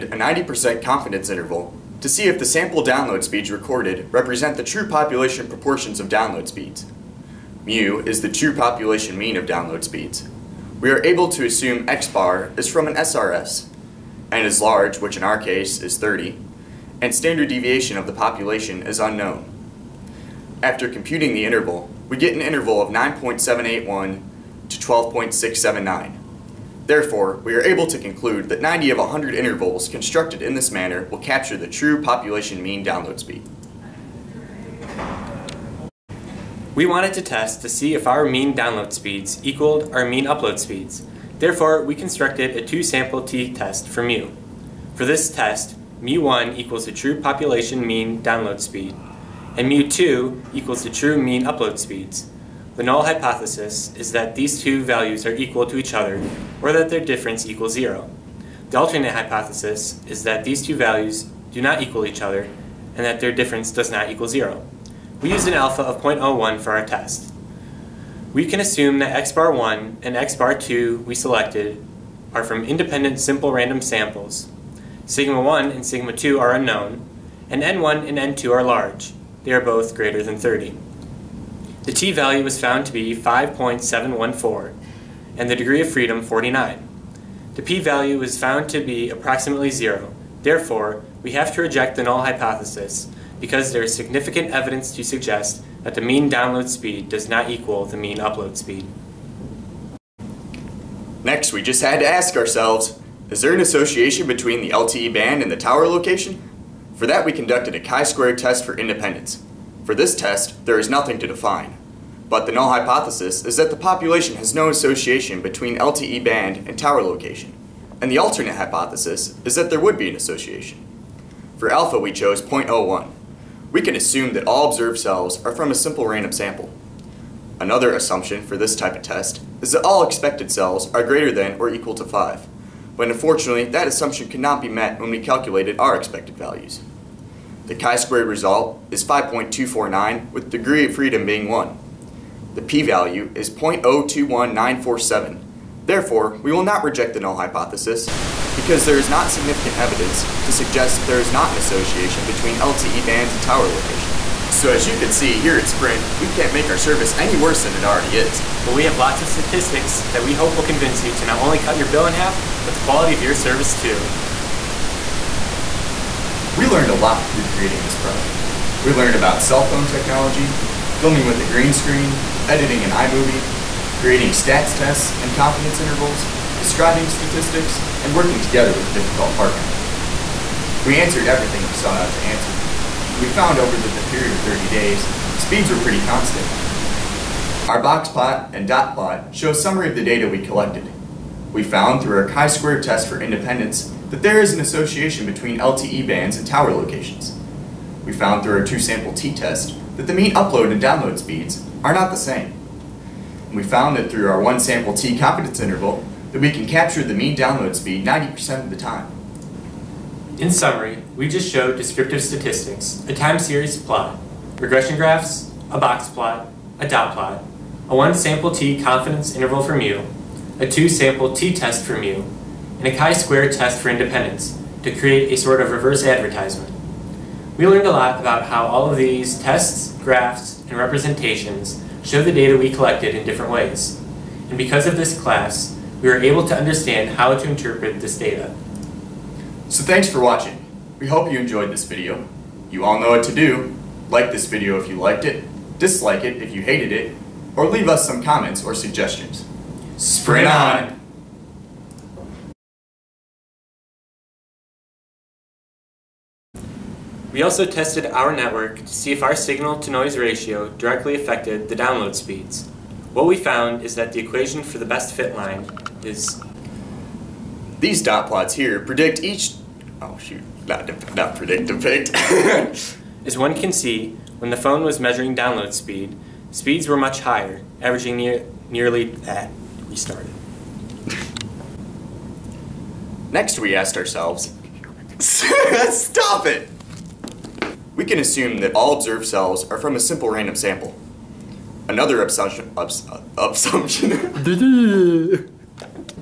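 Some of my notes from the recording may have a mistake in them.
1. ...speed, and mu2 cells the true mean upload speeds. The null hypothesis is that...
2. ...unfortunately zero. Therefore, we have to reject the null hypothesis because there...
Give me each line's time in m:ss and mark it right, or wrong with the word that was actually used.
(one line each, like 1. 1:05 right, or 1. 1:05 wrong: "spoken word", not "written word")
1. 0:48 wrong: "equals", not "cells"
2. 1:29 wrong: "approximately", not "unfortunately".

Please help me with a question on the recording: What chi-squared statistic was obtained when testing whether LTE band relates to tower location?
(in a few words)
5.249.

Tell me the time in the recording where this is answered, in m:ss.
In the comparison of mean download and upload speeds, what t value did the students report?
1:23.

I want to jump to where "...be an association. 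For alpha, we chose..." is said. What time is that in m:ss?
1:59.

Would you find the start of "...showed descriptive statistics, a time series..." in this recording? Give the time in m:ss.
3:31.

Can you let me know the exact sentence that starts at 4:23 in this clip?
What we found is that the equation for the best fit line is these dot plots here predict each.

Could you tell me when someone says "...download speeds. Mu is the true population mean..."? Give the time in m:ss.
0:06.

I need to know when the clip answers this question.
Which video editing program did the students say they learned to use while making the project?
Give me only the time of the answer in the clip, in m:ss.
2:52.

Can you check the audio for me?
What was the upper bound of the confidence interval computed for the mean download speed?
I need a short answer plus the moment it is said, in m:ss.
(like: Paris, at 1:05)
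12.679, at 0:24.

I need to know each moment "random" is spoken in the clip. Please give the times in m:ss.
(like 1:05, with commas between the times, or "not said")
1:13, 2:06, 4:50.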